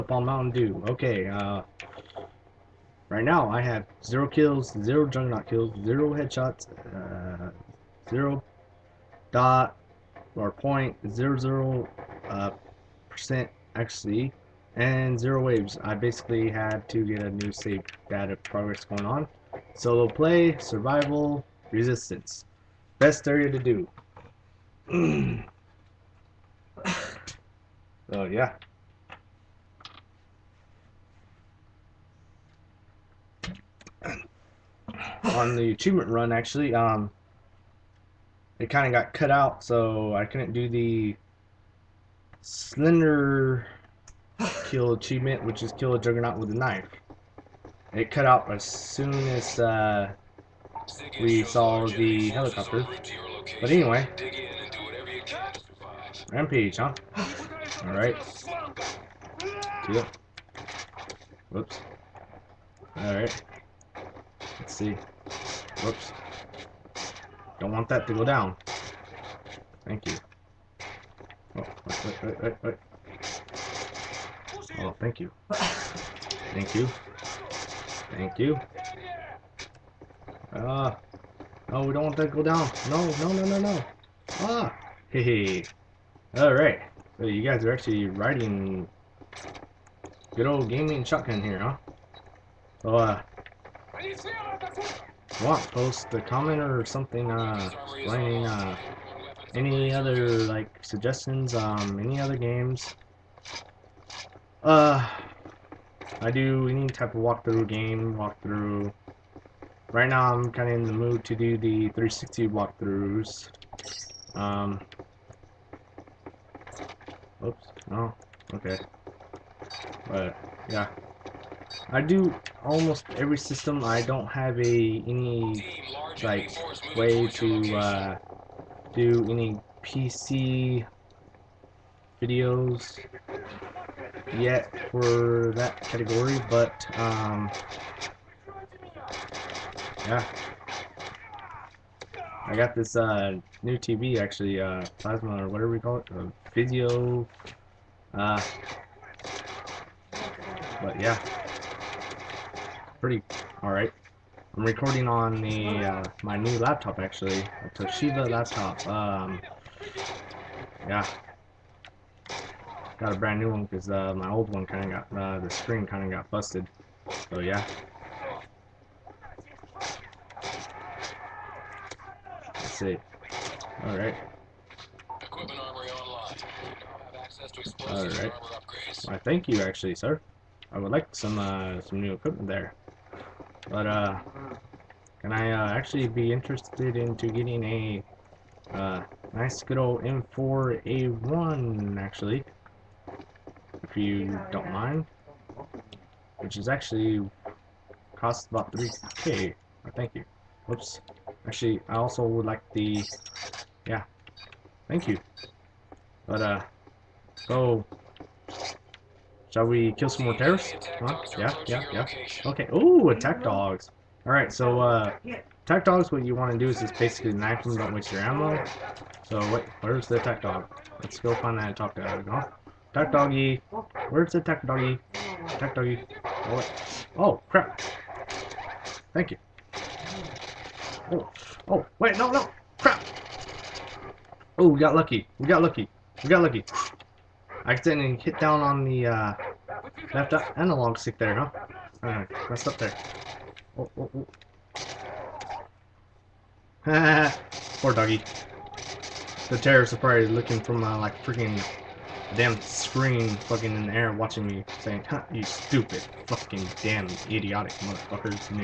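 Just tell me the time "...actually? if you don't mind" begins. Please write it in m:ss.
3:11.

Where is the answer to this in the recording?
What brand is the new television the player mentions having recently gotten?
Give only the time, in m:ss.
2:26.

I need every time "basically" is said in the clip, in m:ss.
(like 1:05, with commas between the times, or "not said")
0:15, 3:36.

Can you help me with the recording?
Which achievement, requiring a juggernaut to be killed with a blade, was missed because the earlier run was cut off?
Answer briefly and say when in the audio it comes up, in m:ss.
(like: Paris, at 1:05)
slender kill, at 0:42.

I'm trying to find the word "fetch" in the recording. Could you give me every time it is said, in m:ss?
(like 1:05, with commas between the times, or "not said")
not said.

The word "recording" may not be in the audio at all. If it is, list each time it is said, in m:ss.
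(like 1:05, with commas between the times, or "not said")
2:34.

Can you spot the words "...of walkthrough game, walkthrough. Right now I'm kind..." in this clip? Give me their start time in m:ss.
1:47.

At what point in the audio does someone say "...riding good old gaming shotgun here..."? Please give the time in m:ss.
1:28.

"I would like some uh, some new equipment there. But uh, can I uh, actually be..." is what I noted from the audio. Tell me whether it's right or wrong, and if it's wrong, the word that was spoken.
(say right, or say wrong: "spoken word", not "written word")
right.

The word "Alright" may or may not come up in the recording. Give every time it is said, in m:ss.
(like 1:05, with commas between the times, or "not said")
1:26, 3:34, 4:02.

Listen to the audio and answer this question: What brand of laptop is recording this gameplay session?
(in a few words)
Toshiba.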